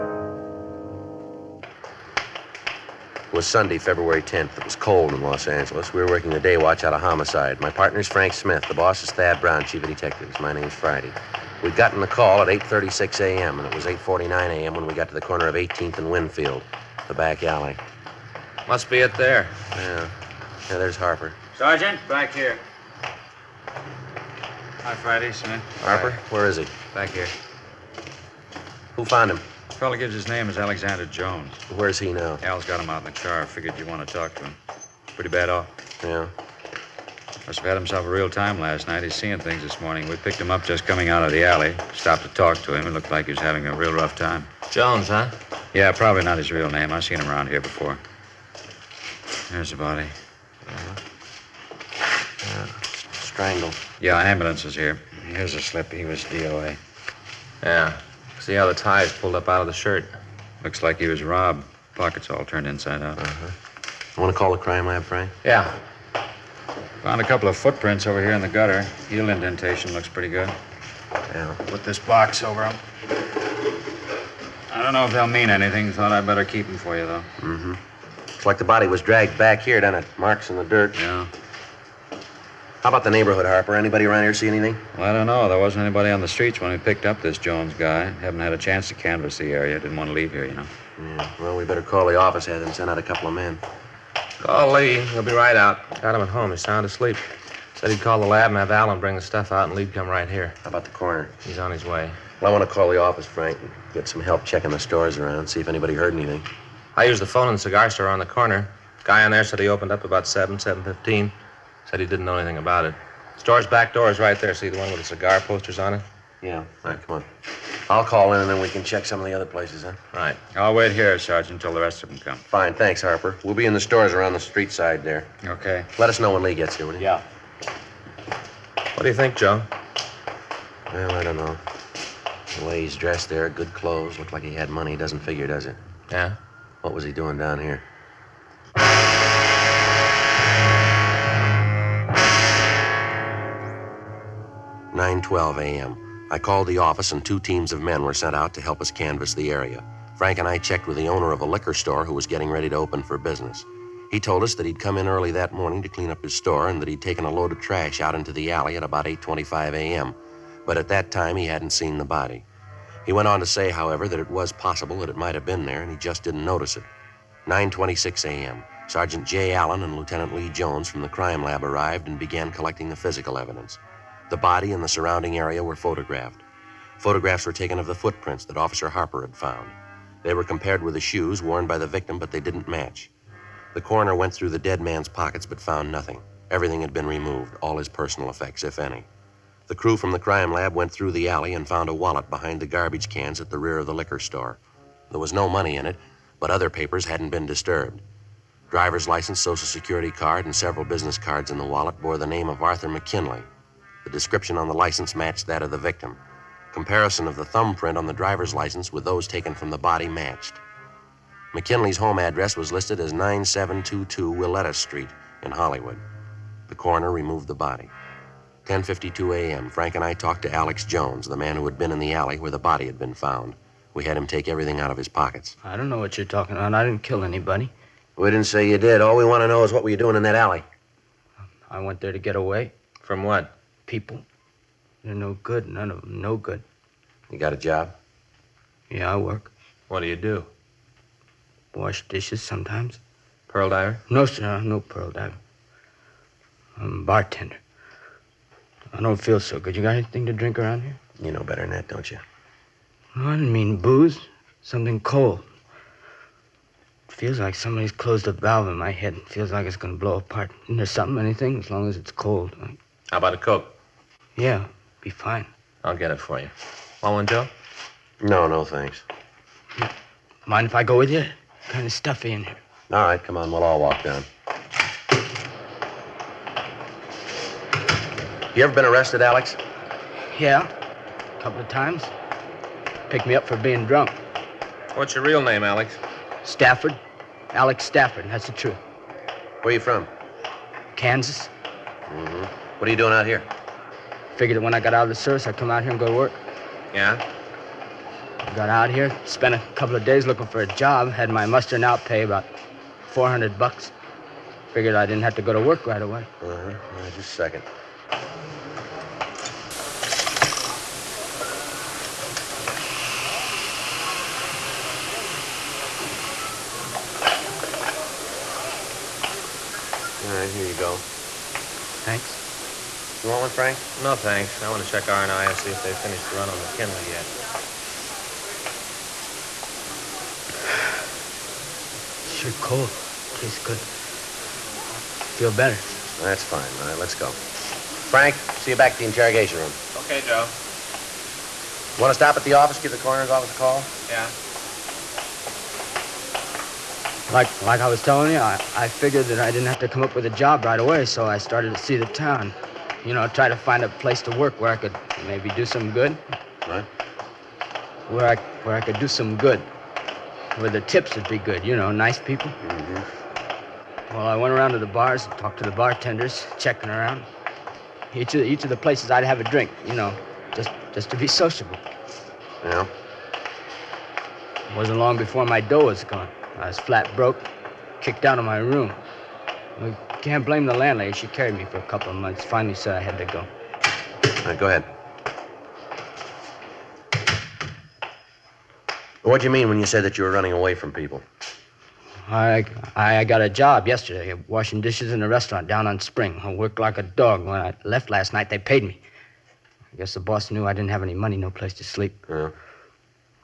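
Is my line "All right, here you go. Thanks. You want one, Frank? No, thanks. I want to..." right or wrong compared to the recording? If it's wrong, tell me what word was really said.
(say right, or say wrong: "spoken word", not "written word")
right.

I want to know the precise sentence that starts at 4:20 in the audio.
Isn't there something, anything, as long as it's cold?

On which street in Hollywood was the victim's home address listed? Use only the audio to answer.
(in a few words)
Willetta Street.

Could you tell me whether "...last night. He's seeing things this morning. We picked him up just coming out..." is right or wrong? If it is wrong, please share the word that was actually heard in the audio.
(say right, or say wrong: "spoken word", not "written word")
right.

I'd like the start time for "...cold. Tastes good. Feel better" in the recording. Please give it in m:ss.
5:32.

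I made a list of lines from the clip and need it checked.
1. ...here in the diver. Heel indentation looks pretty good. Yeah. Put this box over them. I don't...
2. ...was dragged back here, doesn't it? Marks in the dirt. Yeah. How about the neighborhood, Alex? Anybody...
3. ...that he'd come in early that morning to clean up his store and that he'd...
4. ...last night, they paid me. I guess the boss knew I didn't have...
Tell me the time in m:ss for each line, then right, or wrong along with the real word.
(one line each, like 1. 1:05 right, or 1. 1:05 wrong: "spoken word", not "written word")
1. 1:08 wrong: "gutter", not "diver"
2. 1:18 wrong: "Harper", not "Alex"
3. 2:34 right
4. 6:38 right.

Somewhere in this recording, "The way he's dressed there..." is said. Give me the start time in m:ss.
2:12.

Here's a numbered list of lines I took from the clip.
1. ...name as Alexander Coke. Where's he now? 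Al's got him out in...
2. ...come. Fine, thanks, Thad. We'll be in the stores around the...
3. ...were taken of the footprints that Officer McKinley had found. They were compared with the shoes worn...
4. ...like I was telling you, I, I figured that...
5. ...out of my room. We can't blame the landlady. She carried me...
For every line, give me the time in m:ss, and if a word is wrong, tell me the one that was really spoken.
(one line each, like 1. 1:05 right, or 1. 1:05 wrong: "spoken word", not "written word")
1. 0:30 wrong: "Jones", not "Coke"
2. 2:02 wrong: "Harper", not "Thad"
3. 2:57 wrong: "Harper", not "McKinley"
4. 5:47 right
5. 6:18 right.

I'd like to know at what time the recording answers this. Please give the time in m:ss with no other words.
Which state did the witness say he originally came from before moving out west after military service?
4:50.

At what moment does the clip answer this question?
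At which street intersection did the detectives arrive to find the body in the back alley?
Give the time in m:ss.
0:15.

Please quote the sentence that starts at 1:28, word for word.
Haven't had a chance to canvass the area.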